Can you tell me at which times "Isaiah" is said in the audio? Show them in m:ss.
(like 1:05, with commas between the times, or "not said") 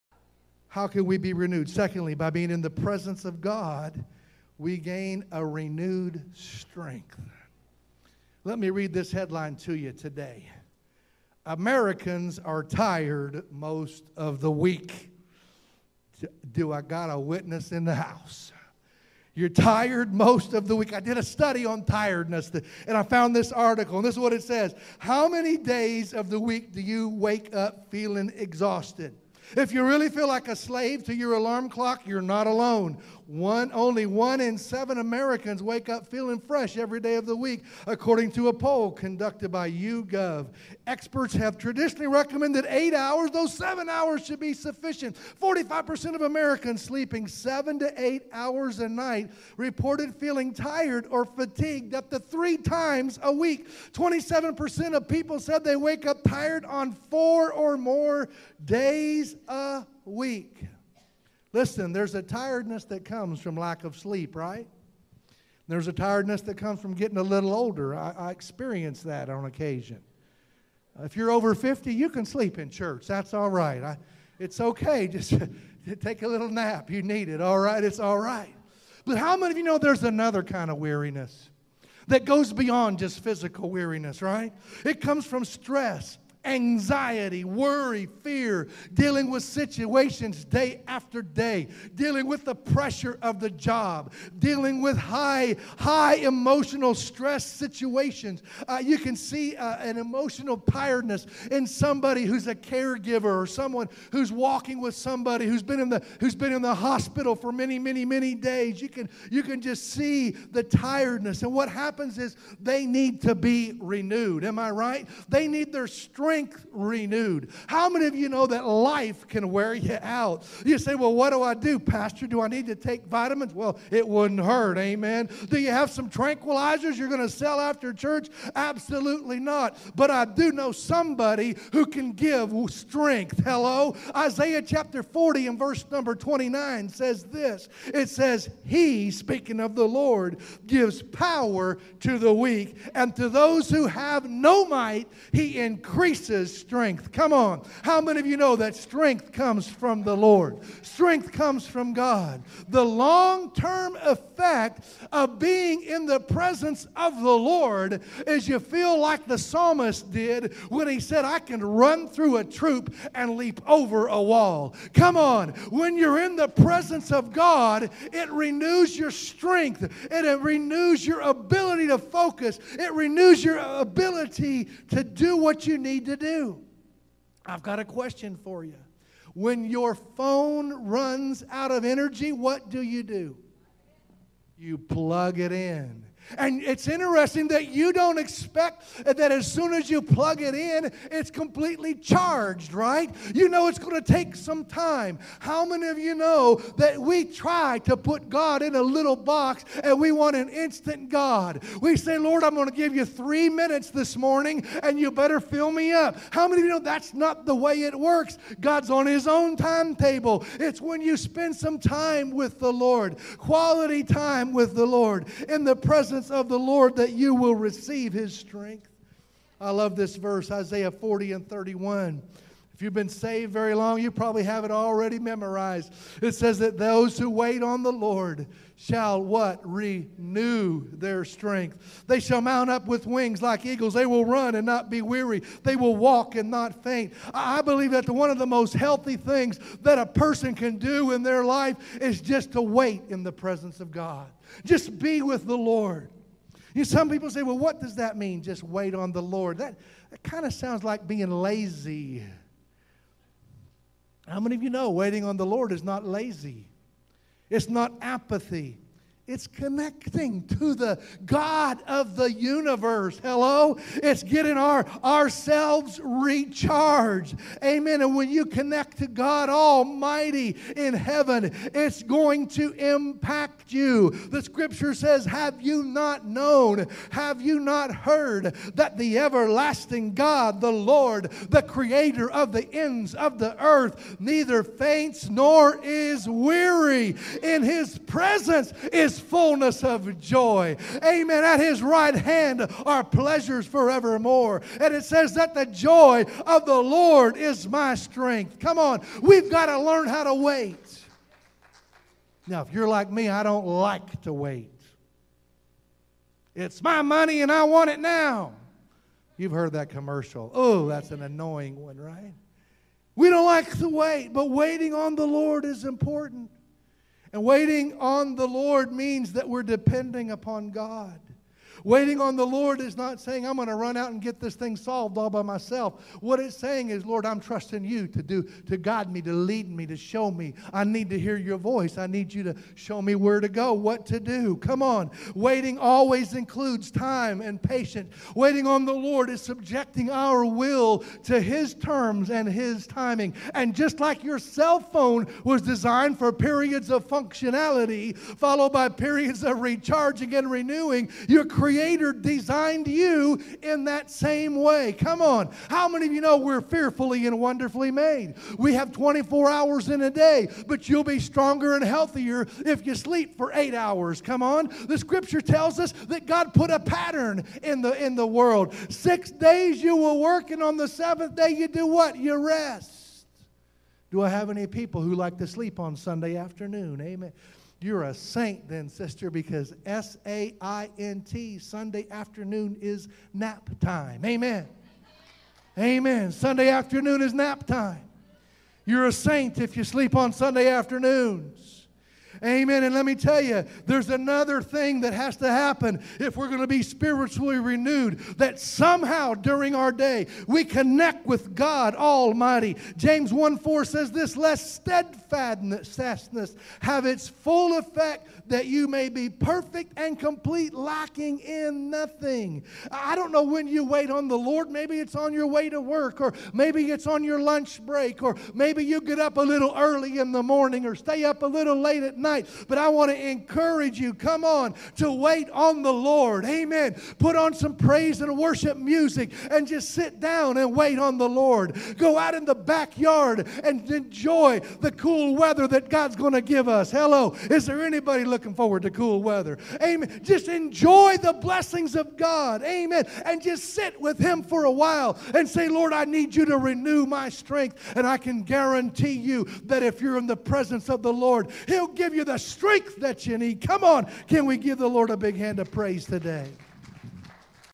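2:14, 3:40.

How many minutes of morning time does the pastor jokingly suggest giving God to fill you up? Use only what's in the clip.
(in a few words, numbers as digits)
3 minutes.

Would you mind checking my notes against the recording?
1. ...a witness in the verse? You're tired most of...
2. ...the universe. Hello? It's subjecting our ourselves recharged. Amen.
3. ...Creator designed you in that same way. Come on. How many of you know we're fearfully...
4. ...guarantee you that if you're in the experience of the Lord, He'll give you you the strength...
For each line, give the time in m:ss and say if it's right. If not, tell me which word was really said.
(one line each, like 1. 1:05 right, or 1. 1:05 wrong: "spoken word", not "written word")
1. 0:17 wrong: "house", not "verse"
2. 4:22 wrong: "getting", not "subjecting"
3. 5:51 right
4. 7:28 wrong: "presence", not "experience".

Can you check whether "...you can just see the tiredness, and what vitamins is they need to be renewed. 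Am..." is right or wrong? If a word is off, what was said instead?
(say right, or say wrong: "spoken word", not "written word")
wrong: "happens", not "vitamins".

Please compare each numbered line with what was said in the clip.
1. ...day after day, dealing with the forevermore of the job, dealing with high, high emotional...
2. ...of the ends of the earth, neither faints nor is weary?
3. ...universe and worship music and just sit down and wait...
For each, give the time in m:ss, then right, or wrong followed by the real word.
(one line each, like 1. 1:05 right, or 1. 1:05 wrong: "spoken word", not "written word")
1. 1:30 wrong: "pressure", not "forevermore"
2. 4:42 right
3. 7:07 wrong: "praise", not "universe".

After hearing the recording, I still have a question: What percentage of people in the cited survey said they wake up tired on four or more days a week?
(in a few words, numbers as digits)
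27%.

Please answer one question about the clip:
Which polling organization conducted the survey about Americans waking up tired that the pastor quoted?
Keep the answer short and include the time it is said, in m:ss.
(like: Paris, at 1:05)
YouGov, at 0:39.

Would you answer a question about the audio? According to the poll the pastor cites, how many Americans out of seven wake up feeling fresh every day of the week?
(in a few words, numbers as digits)
1.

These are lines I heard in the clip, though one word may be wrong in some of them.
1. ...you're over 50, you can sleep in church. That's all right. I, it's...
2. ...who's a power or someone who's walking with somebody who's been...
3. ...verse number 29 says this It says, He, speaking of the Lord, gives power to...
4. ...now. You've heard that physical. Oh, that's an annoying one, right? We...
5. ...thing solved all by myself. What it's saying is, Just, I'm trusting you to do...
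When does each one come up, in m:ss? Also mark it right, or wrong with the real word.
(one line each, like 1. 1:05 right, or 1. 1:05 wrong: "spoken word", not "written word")
1. 1:11 right
2. 1:42 wrong: "caregiver", not "power"
3. 2:15 right
4. 5:07 wrong: "commercial", not "physical"
5. 5:24 wrong: "Lord", not "Just".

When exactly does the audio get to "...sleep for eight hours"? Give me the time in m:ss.
6:02.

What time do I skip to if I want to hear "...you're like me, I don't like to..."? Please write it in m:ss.
5:02.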